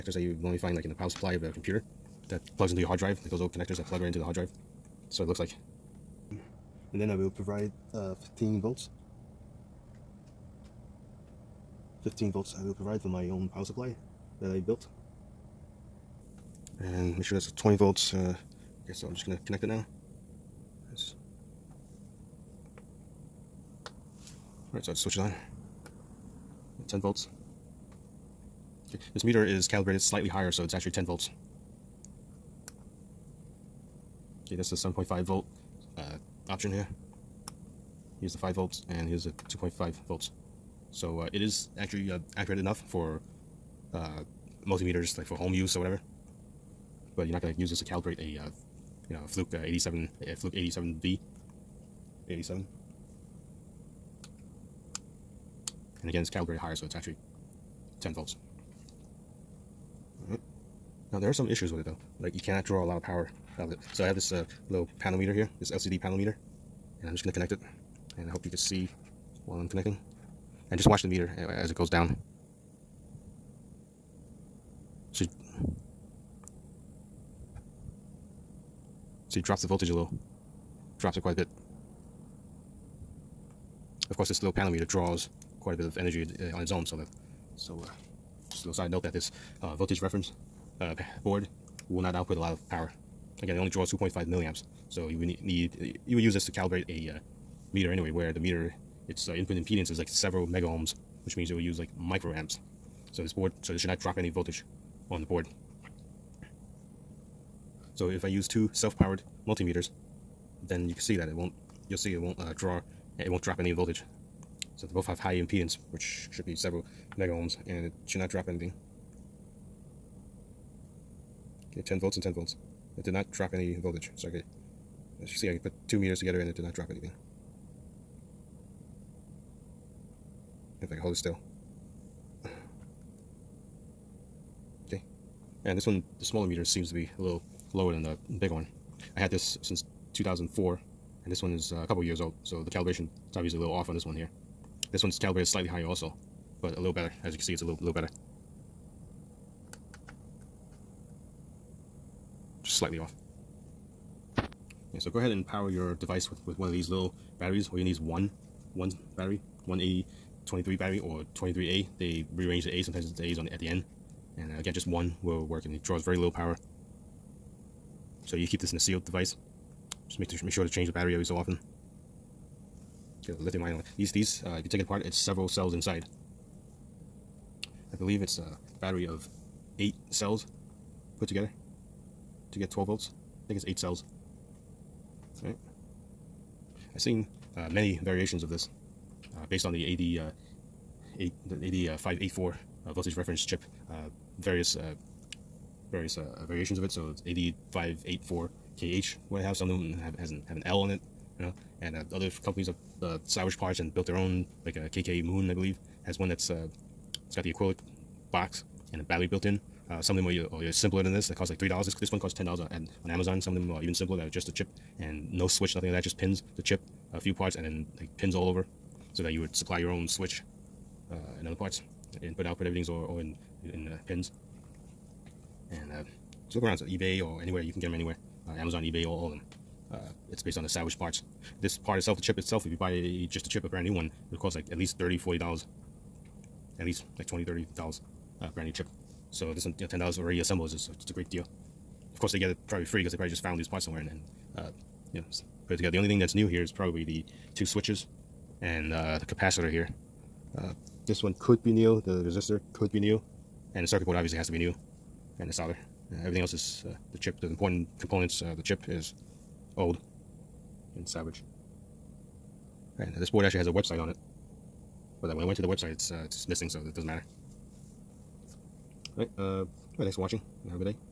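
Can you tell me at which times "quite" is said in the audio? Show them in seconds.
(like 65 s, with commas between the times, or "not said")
81 s, 85 s.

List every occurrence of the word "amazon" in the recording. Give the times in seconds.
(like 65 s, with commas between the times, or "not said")
213 s, 228 s.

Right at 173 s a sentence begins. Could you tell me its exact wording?
These, these uh, if you take it apart, it's several cells inside.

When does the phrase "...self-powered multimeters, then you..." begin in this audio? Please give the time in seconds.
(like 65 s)
108 s.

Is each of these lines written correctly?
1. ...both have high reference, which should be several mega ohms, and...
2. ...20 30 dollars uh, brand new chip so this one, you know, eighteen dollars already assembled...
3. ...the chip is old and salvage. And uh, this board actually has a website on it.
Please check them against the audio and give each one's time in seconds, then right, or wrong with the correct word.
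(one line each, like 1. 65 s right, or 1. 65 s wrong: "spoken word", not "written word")
1. 114 s wrong: "impedance", not "reference"
2. 237 s wrong: "ten", not "eighteen"
3. 258 s right.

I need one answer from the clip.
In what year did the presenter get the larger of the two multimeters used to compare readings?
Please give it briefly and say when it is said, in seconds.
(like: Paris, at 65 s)
2004, at 140 s.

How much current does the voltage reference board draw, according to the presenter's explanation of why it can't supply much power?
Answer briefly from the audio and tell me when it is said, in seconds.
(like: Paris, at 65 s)
2.5 milliamps, at 93 s.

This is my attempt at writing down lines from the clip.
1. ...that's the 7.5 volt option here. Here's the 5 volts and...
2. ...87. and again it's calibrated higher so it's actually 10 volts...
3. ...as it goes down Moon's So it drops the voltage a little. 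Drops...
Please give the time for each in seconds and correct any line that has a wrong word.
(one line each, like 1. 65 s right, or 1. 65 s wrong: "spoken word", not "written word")
1. 34 s right
2. 52 s right
3. 71 s wrong: "She", not "Moon".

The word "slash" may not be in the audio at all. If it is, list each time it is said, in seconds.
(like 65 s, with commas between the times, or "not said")
not said.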